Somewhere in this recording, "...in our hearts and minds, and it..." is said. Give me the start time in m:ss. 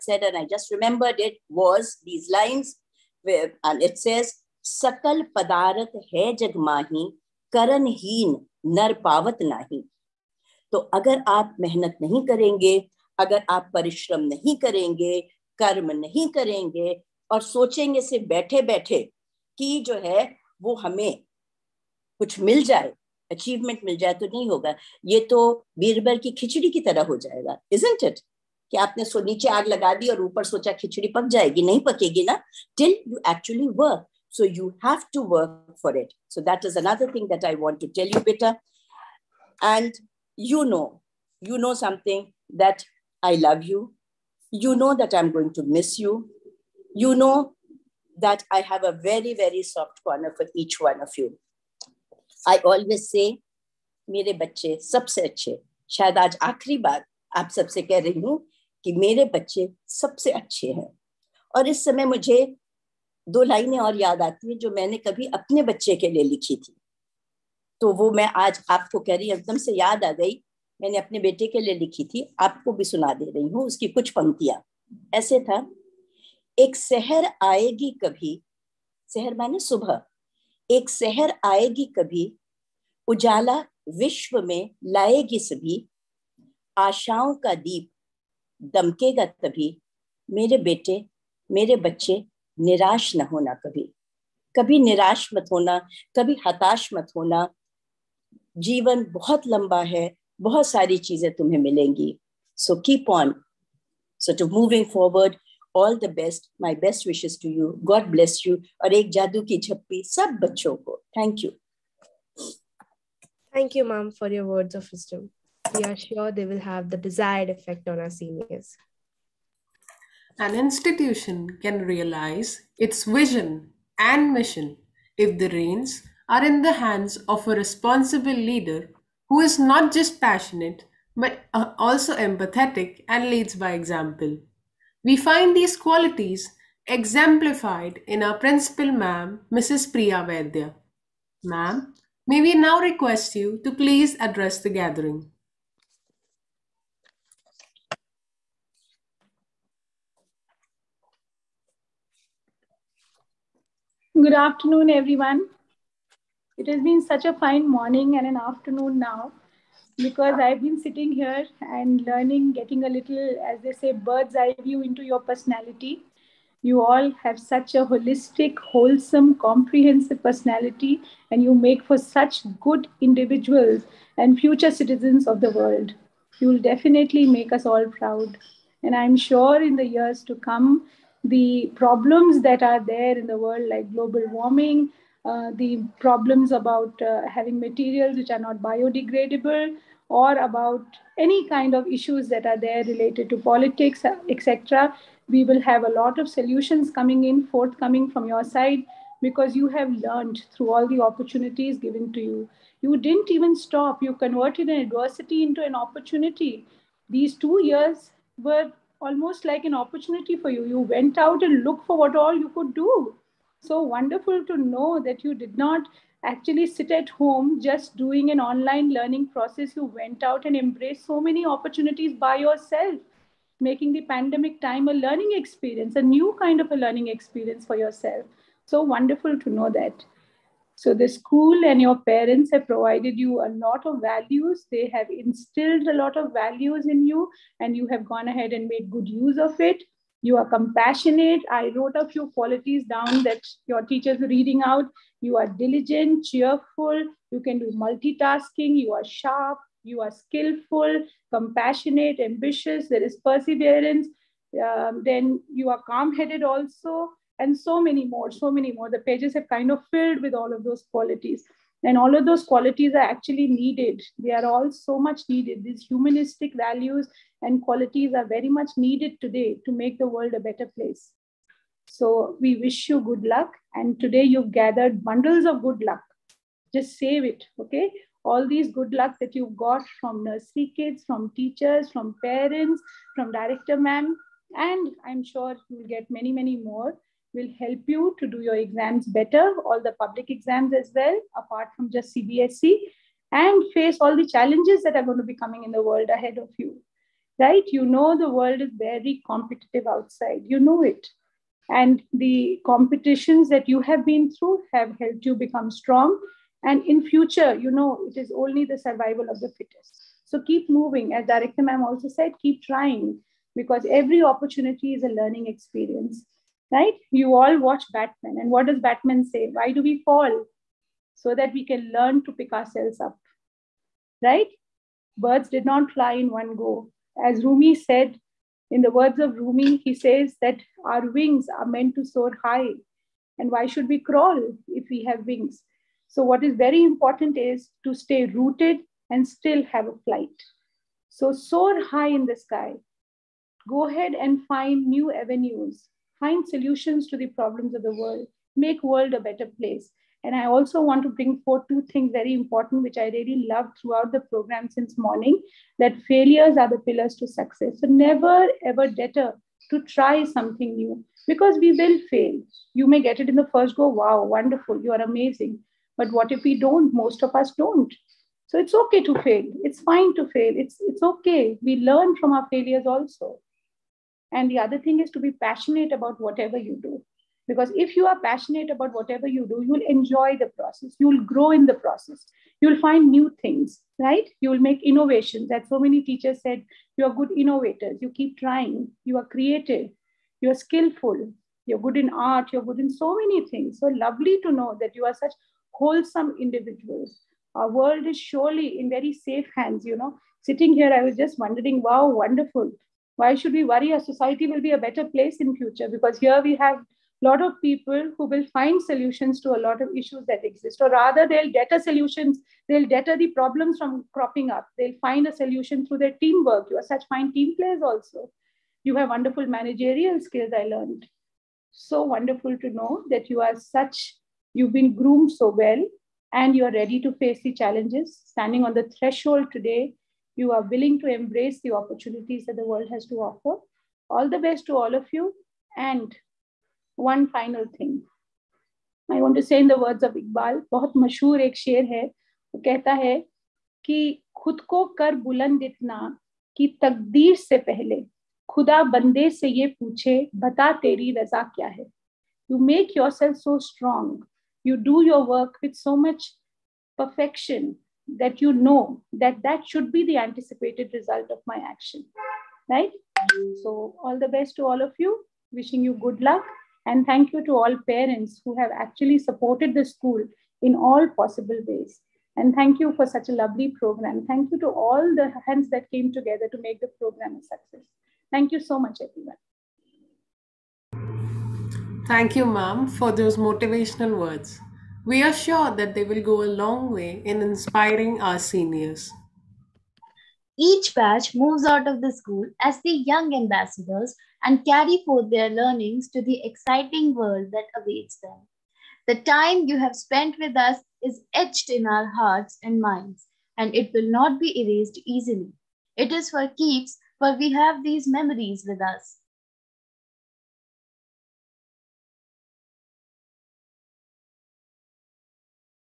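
8:21.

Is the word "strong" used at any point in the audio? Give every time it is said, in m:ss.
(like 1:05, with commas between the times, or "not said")
5:05, 7:33.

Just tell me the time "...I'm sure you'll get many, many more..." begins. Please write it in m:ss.
4:45.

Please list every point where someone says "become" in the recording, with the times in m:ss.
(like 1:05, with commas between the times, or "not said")
5:05.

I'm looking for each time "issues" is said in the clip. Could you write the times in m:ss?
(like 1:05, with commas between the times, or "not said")
3:11, 6:49.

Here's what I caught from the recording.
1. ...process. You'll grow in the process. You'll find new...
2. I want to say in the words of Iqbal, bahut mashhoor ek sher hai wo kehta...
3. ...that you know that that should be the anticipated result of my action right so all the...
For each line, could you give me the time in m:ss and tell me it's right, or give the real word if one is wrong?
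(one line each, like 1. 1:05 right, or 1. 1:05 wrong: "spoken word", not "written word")
1. 6:20 right
2. 7:19 right
3. 7:38 right.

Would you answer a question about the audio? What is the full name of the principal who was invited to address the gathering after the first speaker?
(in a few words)
Priya Vaidya.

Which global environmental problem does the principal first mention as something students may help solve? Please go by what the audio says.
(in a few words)
Global warming.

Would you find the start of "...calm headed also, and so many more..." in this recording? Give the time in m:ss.
4:15.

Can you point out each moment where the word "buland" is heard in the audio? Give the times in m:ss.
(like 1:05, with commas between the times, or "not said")
7:25.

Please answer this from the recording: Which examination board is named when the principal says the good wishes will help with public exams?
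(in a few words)
CBSE.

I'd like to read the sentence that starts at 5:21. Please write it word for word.
So that we can learn to pick ourselves up, right?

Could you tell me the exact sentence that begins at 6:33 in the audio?
So lovely to know that you are such wholesome individuals.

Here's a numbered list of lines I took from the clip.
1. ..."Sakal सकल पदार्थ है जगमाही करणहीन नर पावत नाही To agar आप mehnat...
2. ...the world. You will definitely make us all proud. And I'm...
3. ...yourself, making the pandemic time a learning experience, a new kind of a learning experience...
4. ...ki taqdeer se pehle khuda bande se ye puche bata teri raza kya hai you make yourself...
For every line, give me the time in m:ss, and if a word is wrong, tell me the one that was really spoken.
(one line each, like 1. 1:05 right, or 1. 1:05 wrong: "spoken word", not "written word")
1. 0:04 right
2. 2:55 right
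3. 3:42 right
4. 7:26 right.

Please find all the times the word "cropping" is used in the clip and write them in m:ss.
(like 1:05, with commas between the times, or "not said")
6:54.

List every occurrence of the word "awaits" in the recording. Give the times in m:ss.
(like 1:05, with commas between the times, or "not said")
8:17.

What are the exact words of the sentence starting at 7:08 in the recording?
Standing on the threshold today you are willing to embrace the opportunities that the world has to offer.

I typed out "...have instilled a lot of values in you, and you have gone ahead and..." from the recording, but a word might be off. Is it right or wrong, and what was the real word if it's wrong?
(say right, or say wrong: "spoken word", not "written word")
right.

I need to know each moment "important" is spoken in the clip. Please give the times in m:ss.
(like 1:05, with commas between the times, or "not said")
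5:36, 5:52.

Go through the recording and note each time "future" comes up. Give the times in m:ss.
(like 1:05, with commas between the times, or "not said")
2:54, 5:07, 6:45.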